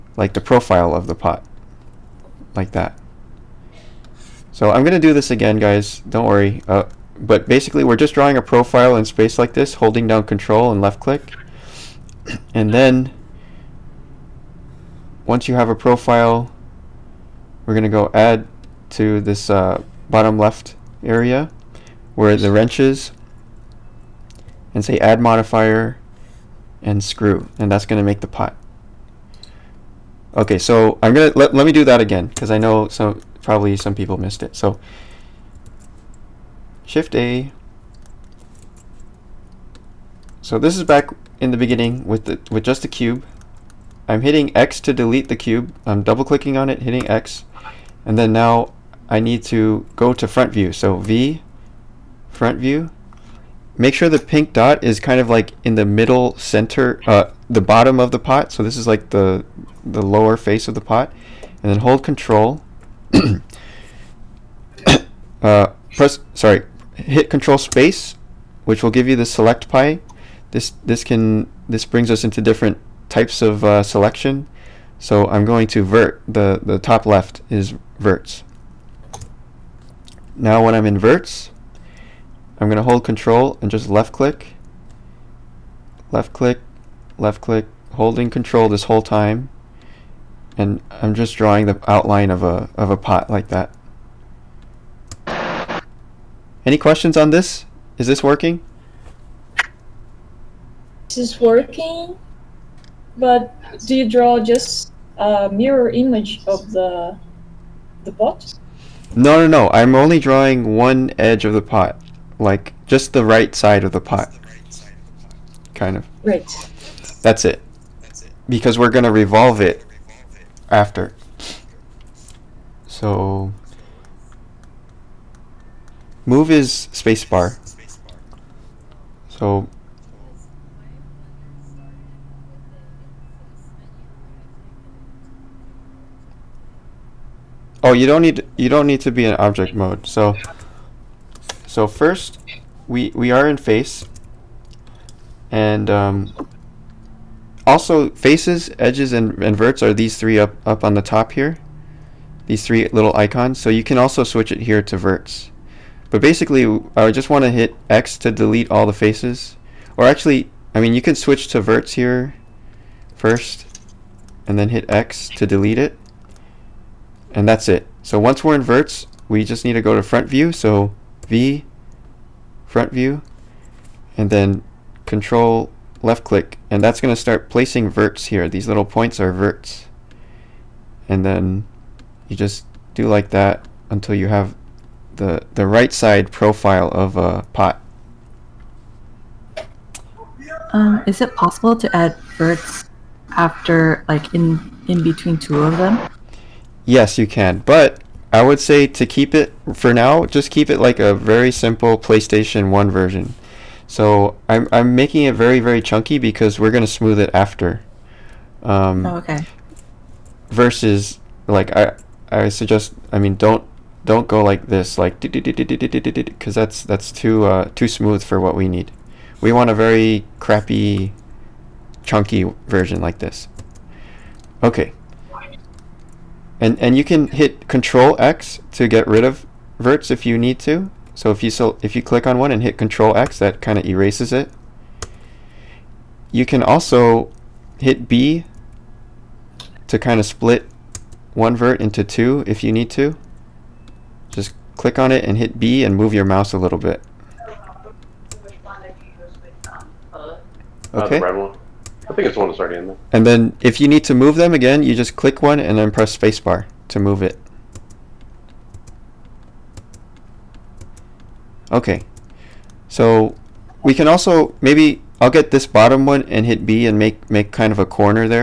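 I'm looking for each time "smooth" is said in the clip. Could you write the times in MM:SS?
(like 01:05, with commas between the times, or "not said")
03:26, 03:37.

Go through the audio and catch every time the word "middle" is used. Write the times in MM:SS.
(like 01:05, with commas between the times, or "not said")
00:55.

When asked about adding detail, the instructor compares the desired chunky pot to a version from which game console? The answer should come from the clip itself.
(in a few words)
PlayStation 1.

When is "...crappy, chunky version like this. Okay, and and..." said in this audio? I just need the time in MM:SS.
03:40.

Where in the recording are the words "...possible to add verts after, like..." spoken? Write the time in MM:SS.
03:11.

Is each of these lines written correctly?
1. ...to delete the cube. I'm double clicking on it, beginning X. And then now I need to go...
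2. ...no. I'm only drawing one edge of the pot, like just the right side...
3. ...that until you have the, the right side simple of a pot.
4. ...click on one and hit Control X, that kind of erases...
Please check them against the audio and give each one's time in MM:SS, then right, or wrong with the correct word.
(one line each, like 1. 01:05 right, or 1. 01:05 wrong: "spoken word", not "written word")
1. 00:44 wrong: "hitting", not "beginning"
2. 01:49 right
3. 03:03 wrong: "profile", not "simple"
4. 03:52 right.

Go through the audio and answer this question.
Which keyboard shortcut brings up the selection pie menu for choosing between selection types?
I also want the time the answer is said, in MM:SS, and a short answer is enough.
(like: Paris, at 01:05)
Control space, at 01:07.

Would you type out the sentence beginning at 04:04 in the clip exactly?
Just click on it and hit B and move your mouse a little bit.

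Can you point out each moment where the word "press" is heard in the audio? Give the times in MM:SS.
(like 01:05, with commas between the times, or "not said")
01:05, 04:15.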